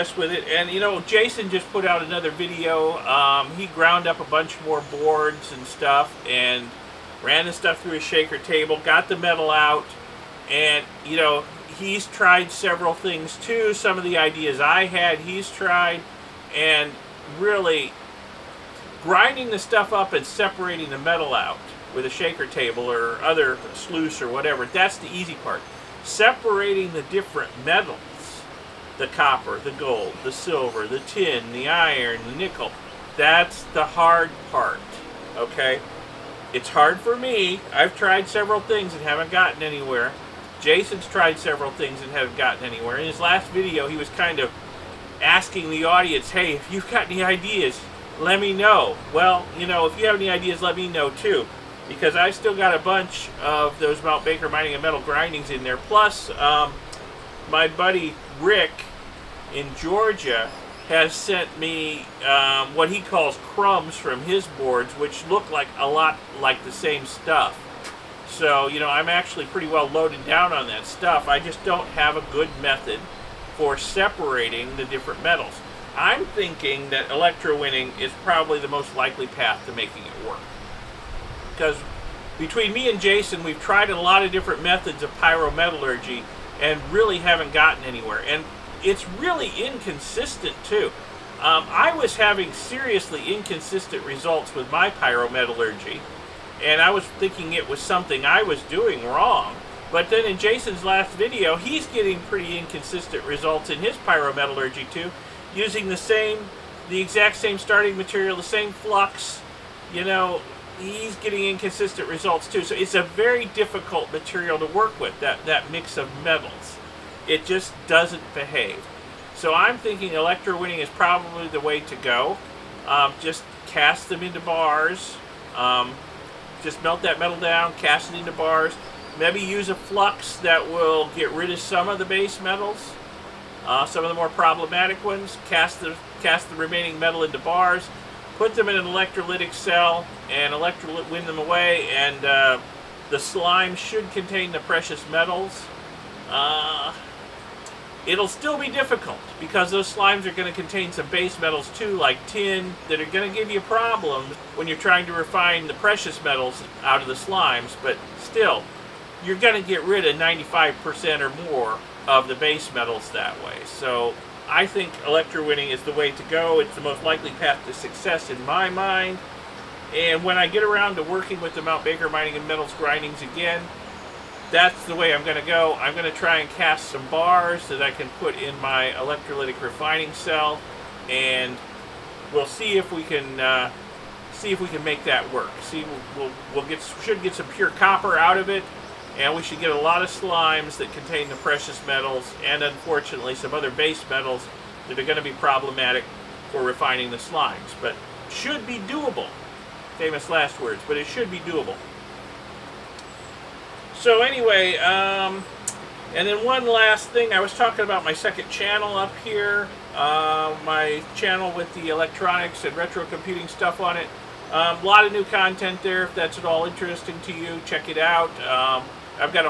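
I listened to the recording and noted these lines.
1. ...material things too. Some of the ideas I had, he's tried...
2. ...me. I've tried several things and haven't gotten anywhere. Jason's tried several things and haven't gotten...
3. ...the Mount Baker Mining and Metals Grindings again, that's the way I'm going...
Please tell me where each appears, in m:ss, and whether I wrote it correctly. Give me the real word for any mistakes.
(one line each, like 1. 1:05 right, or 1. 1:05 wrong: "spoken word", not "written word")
1. 0:12 wrong: "several", not "material"
2. 0:37 right
3. 2:51 right.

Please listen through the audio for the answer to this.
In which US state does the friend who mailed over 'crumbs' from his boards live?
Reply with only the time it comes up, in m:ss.
0:59.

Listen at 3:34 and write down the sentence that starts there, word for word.
A um, lot of new content there.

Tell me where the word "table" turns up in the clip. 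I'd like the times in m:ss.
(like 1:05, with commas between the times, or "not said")
0:08, 0:22.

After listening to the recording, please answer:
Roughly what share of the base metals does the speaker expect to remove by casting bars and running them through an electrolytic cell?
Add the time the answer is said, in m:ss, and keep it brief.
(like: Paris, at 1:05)
95% or more, at 2:40.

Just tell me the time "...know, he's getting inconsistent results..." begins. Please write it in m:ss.
1:50.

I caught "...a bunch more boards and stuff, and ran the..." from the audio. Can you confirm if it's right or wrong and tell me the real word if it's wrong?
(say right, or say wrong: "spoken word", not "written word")
right.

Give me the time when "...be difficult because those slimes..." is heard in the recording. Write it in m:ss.
2:28.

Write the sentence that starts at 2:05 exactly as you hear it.
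Um, just melt that metal down, cast it into bars.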